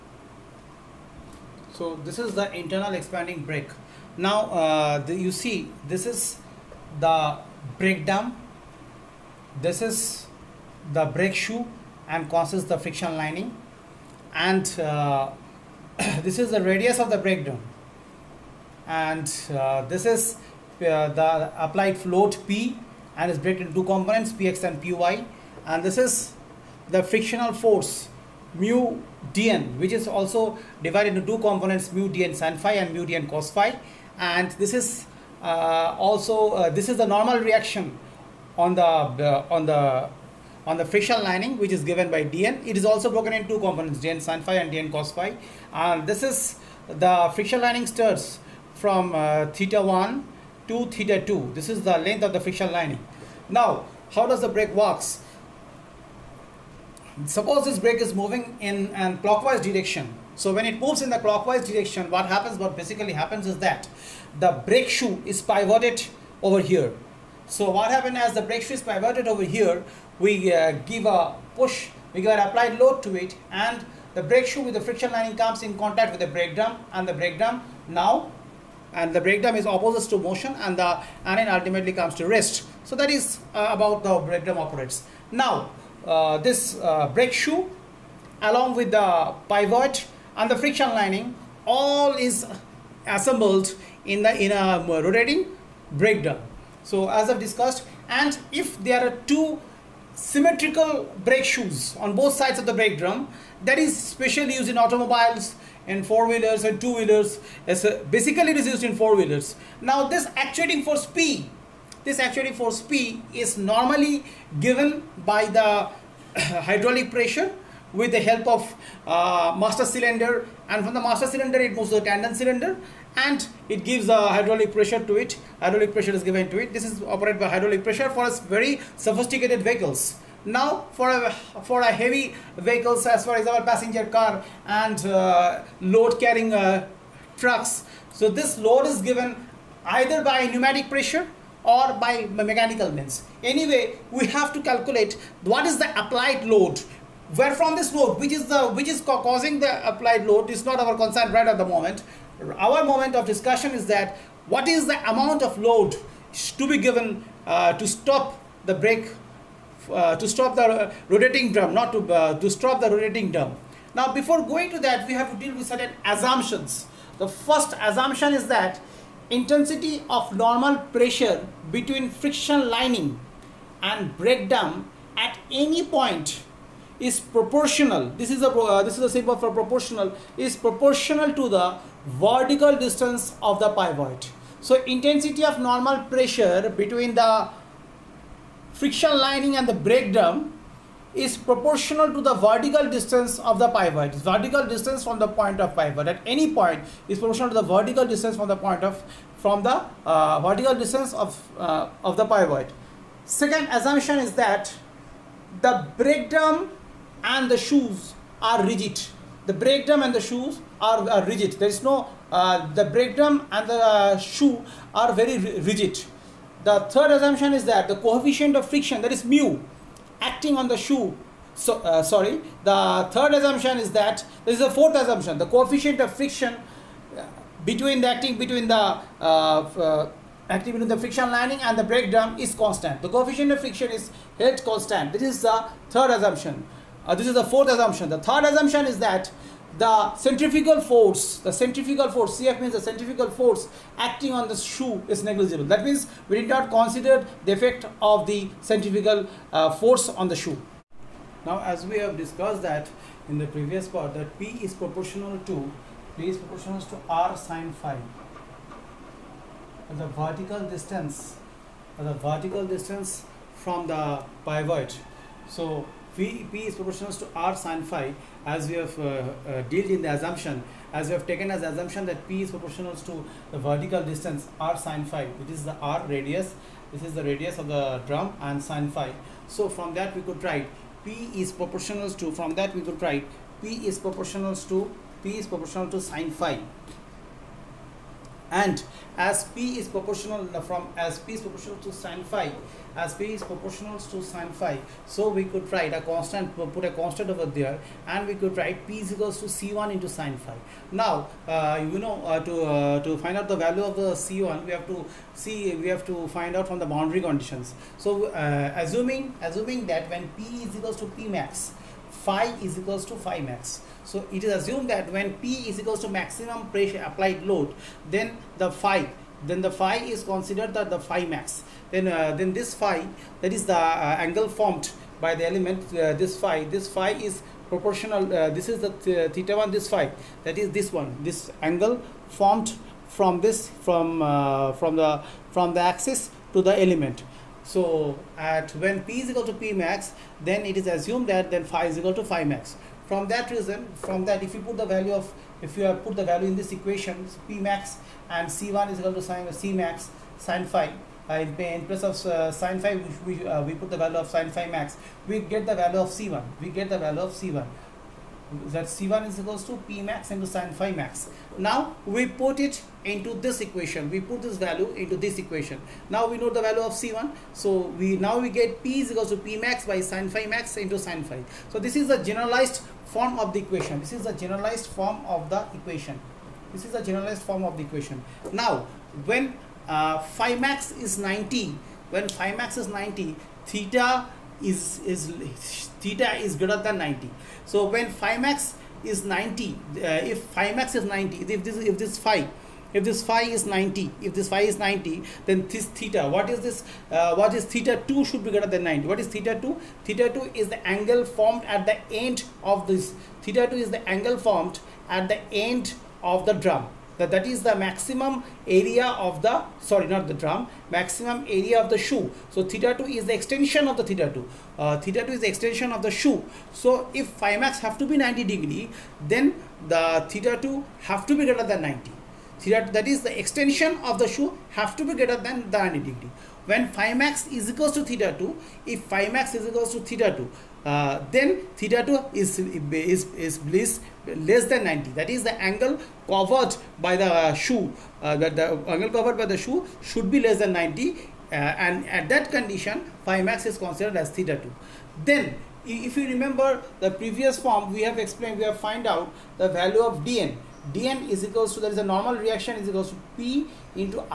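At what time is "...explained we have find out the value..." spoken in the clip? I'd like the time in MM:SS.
07:28.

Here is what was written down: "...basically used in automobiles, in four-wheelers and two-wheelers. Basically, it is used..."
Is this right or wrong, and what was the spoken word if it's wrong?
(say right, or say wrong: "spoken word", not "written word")
wrong: "specially", not "basically".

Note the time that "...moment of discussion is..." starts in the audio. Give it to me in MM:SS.
02:32.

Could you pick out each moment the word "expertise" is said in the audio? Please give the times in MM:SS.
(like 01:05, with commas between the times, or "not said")
not said.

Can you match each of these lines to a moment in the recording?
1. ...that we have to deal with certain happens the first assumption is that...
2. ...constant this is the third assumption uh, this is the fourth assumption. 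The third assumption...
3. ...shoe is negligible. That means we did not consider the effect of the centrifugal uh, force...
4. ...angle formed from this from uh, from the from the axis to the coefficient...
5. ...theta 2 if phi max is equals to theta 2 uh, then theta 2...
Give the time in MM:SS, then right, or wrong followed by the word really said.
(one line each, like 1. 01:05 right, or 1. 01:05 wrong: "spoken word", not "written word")
1. 02:44 wrong: "assumptions", not "happens"
2. 03:54 right
3. 04:04 right
4. 05:31 wrong: "element", not "coefficient"
5. 07:08 right.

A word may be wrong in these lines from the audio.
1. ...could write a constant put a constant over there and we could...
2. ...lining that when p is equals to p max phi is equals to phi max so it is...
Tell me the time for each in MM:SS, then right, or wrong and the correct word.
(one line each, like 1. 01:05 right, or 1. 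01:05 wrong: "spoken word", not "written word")
1. 04:55 right
2. 05:09 wrong: "assuming", not "lining".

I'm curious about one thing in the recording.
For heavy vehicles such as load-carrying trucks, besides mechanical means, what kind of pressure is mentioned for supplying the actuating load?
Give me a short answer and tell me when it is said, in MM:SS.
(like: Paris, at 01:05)
Pneumatic pressure, at 02:20.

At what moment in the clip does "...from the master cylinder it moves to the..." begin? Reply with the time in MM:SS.
02:00.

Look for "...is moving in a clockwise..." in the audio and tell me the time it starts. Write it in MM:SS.
00:58.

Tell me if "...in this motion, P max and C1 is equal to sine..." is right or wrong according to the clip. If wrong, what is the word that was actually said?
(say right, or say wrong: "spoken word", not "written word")
wrong: "equation", not "motion".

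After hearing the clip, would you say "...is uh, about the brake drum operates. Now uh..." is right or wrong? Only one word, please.
right.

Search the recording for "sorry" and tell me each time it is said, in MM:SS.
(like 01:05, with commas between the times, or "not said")
03:42, 06:49.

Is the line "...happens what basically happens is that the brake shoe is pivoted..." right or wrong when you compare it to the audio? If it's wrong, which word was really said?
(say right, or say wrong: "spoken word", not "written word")
right.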